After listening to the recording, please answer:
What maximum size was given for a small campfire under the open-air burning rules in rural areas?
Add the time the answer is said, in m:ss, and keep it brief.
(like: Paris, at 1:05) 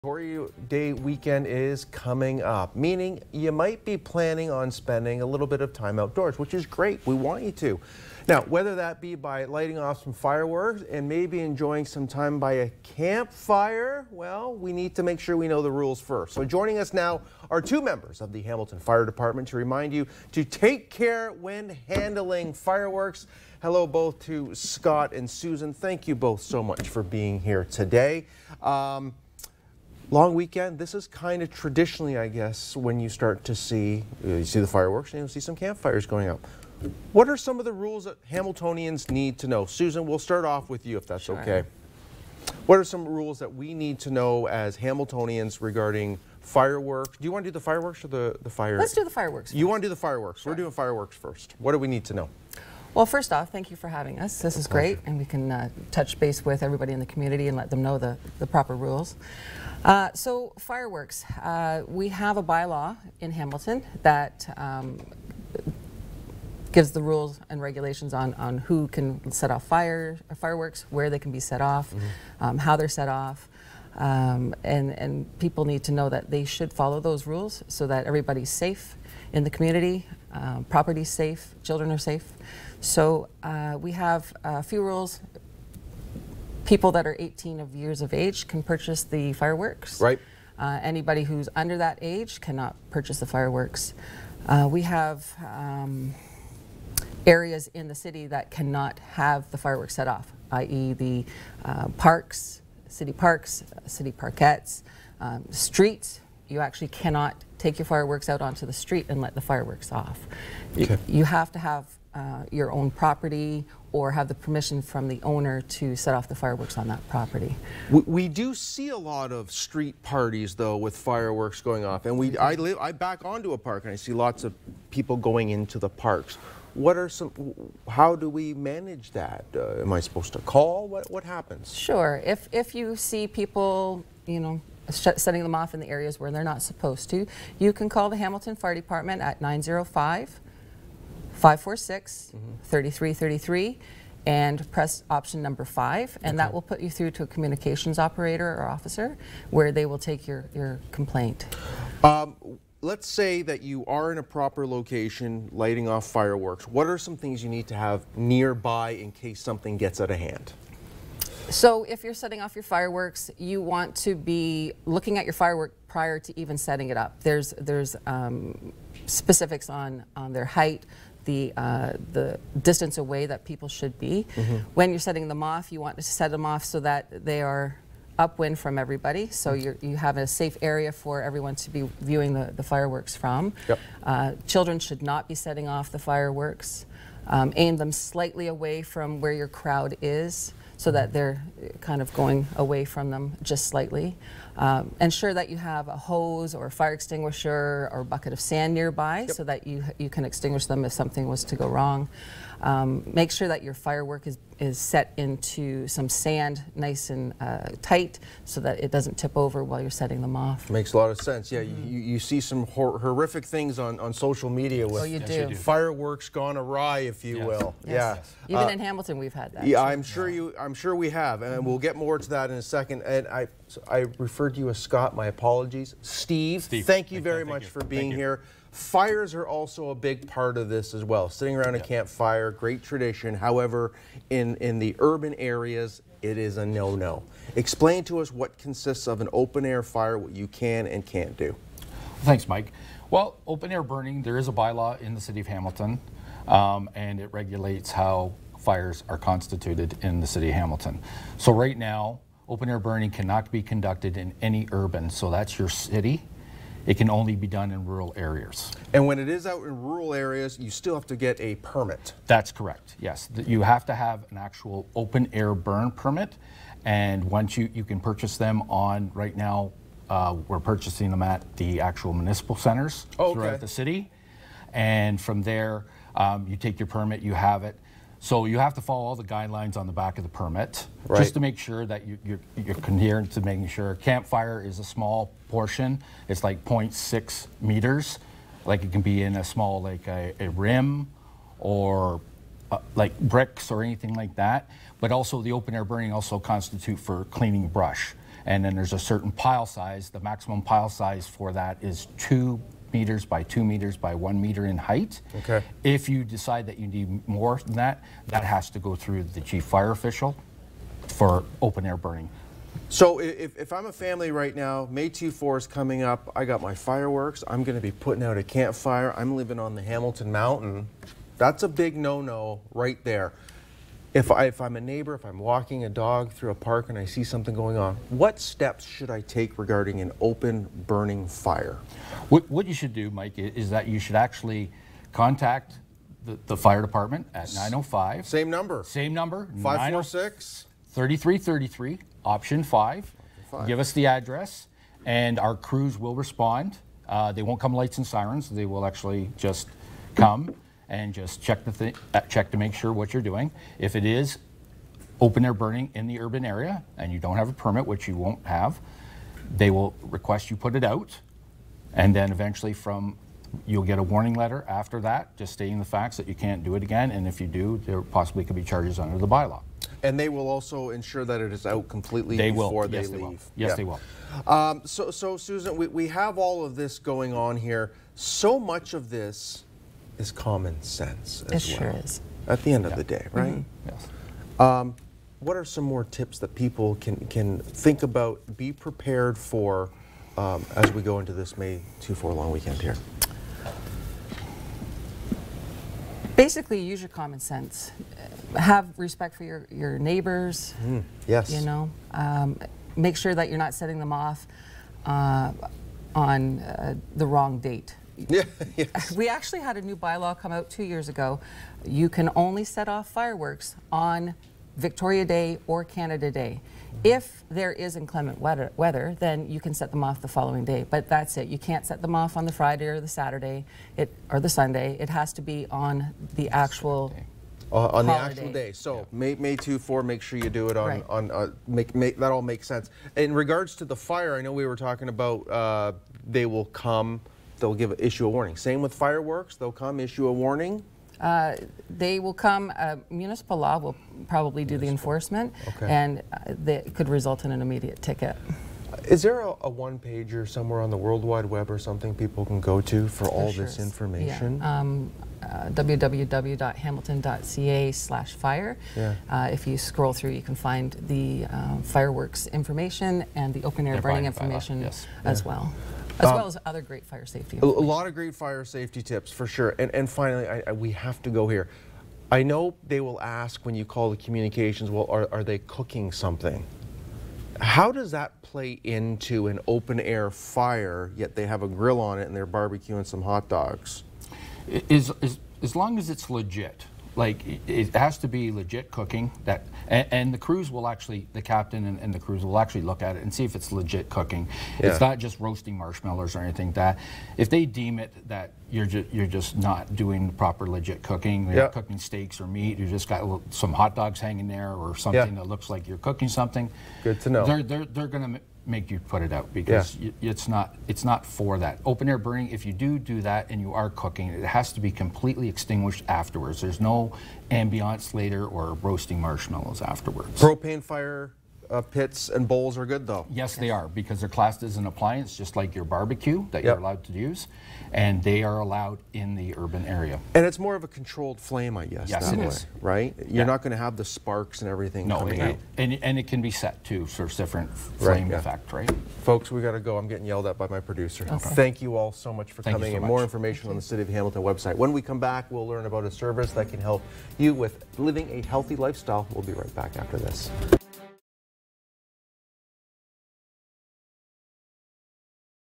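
0.6 meters, at 4:46.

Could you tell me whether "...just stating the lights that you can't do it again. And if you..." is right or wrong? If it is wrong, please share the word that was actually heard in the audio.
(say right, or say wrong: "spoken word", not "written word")
wrong: "facts", not "lights".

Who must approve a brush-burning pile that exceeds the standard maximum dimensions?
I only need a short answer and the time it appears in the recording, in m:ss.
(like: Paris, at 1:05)
The chief fire official, at 5:09.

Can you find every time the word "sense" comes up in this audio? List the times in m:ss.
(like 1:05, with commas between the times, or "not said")
3:31, 6:20, 6:37, 7:12.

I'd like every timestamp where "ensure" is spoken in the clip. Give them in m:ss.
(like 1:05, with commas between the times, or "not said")
3:14, 6:10.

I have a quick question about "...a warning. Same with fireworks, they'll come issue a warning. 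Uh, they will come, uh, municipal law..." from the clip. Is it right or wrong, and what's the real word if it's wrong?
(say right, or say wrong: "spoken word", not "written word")
right.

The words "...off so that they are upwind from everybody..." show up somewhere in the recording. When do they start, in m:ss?
2:56.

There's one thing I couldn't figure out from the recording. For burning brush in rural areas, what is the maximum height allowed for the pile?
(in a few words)
1 meter.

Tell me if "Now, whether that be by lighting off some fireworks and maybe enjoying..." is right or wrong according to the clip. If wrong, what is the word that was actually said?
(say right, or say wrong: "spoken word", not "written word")
right.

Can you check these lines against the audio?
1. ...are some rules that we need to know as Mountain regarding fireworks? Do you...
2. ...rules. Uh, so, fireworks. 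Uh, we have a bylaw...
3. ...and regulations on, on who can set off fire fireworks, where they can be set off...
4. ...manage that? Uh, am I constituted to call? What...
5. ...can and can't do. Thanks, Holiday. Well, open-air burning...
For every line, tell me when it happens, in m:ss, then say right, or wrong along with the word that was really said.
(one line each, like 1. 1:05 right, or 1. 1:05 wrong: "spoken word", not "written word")
1. 0:42 wrong: "Hamiltonians", not "Mountain"
2. 0:58 right
3. 1:07 right
4. 2:08 wrong: "supposed", not "constituted"
5. 4:00 wrong: "Mike", not "Holiday".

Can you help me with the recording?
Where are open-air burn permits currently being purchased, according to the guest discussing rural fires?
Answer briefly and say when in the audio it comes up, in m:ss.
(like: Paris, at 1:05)
Municipal centers, at 4:32.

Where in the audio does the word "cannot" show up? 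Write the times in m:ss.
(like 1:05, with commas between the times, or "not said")
1:32, 1:38, 1:46, 4:13.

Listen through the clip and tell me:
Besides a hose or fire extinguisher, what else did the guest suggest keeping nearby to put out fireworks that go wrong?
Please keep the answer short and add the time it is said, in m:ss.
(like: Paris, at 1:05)
A bucket of sand, at 3:17.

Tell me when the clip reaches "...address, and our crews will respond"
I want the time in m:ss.
5:44.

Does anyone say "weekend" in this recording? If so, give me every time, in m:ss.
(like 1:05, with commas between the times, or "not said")
0:00, 0:30, 6:32.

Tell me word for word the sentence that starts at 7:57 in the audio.
How does that play into an open air fire, yet they have a grill on it and they're barbecuing some hot dogs?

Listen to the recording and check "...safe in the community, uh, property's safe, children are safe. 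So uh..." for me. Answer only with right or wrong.
right.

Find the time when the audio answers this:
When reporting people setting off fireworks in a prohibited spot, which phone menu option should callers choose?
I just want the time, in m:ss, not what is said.
2:25.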